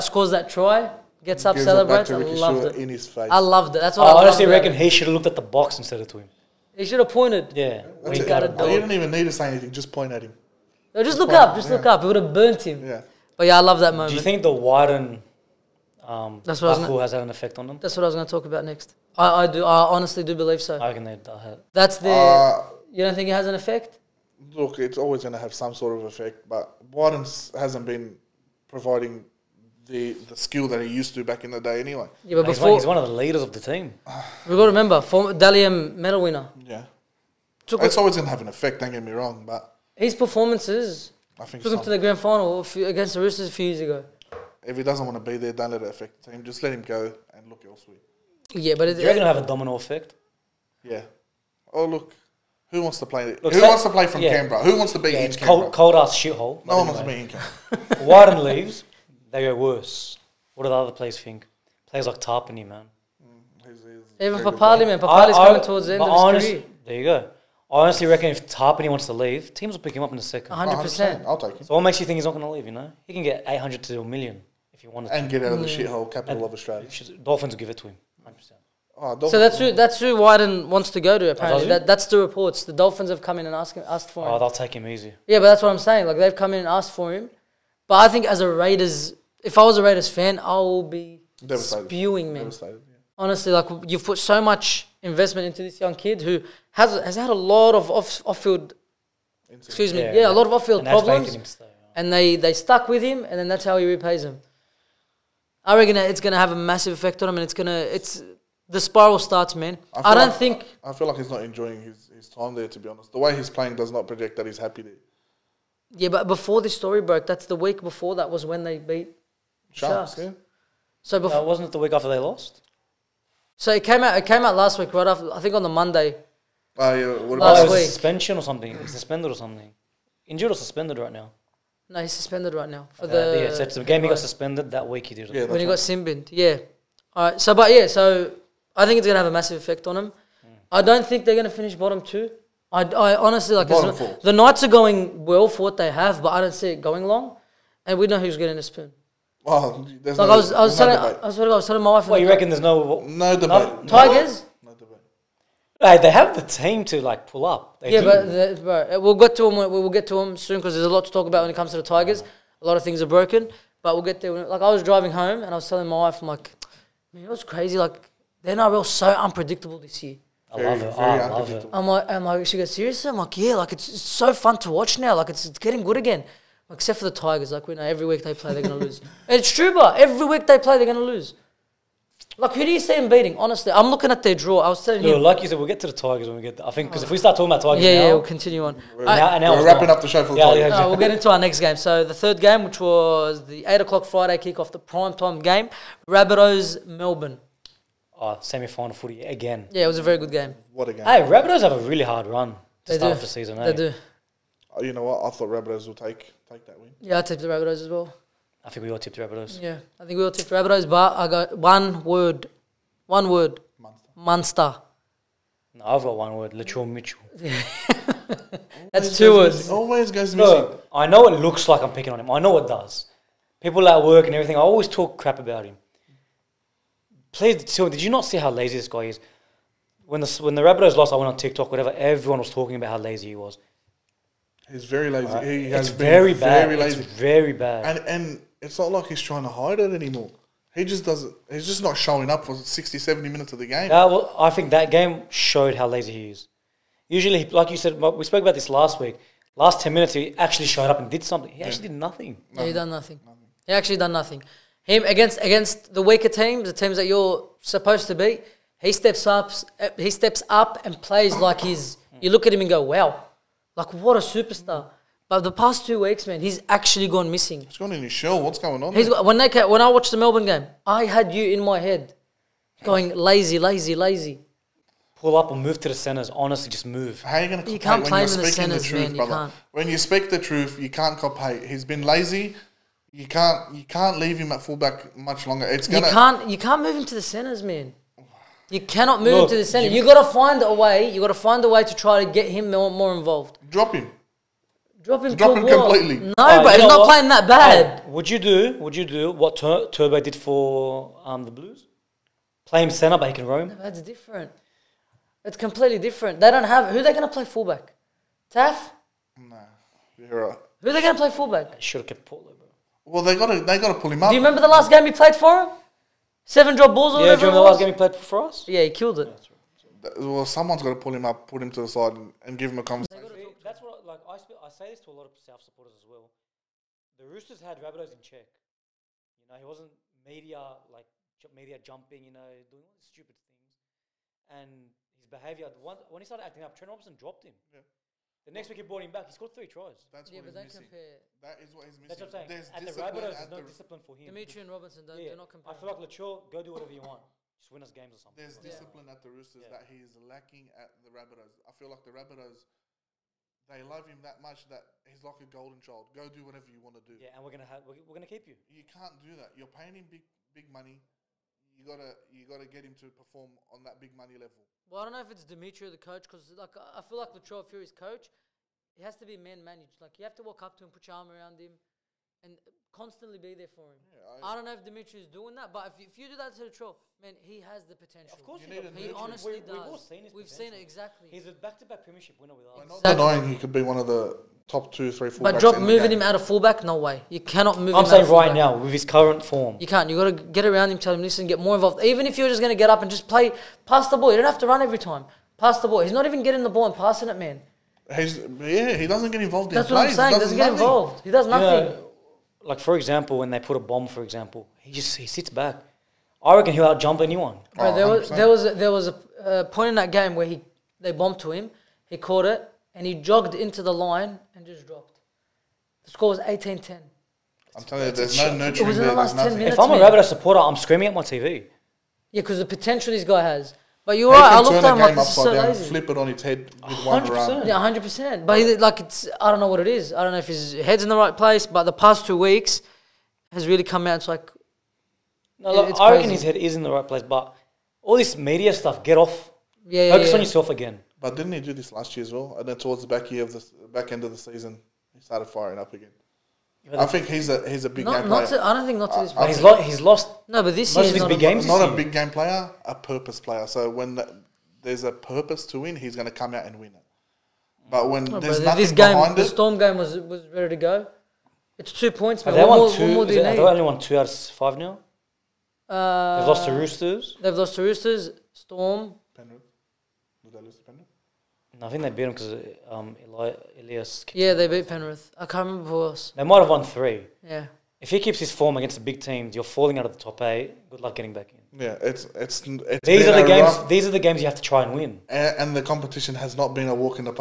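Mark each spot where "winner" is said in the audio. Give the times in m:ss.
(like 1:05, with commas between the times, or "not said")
0:36, 6:22.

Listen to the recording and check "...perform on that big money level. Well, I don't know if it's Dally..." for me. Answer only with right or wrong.
wrong.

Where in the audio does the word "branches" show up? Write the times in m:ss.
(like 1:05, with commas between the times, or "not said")
not said.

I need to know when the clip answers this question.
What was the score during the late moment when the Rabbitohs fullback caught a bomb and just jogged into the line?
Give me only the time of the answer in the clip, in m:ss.
6:56.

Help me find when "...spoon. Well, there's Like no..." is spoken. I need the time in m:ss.
2:28.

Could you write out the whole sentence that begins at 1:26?
Like they've come in and asked for him.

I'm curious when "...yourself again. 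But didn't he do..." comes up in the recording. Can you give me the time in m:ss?
7:20.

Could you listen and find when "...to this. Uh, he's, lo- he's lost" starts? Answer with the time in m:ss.
7:29.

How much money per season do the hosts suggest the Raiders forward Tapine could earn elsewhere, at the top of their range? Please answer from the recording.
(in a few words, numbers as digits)
a million.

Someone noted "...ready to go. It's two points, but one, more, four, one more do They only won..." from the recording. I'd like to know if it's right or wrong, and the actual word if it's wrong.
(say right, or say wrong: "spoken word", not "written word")
wrong: "two", not "four".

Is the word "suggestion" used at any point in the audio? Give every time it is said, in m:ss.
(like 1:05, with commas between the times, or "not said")
not said.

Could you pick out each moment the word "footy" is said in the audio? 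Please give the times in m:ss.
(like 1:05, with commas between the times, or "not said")
3:18.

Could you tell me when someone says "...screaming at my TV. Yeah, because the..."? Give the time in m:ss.
7:00.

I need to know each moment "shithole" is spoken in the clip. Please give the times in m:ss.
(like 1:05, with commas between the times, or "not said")
0:56, 1:15.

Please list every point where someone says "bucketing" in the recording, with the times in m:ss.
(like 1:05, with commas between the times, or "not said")
not said.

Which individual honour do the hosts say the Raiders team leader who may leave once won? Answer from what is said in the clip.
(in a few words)
Dally M medal.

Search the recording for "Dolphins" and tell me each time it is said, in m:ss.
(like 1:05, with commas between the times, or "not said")
1:17, 1:22.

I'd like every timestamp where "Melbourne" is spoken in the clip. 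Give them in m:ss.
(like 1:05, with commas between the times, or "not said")
3:16, 4:30.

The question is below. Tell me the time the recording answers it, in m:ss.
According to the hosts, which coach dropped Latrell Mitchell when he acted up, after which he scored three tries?
5:36.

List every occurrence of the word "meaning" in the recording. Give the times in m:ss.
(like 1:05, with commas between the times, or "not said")
not said.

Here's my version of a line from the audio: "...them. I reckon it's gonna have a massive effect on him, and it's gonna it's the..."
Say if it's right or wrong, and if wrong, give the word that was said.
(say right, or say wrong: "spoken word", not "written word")
right.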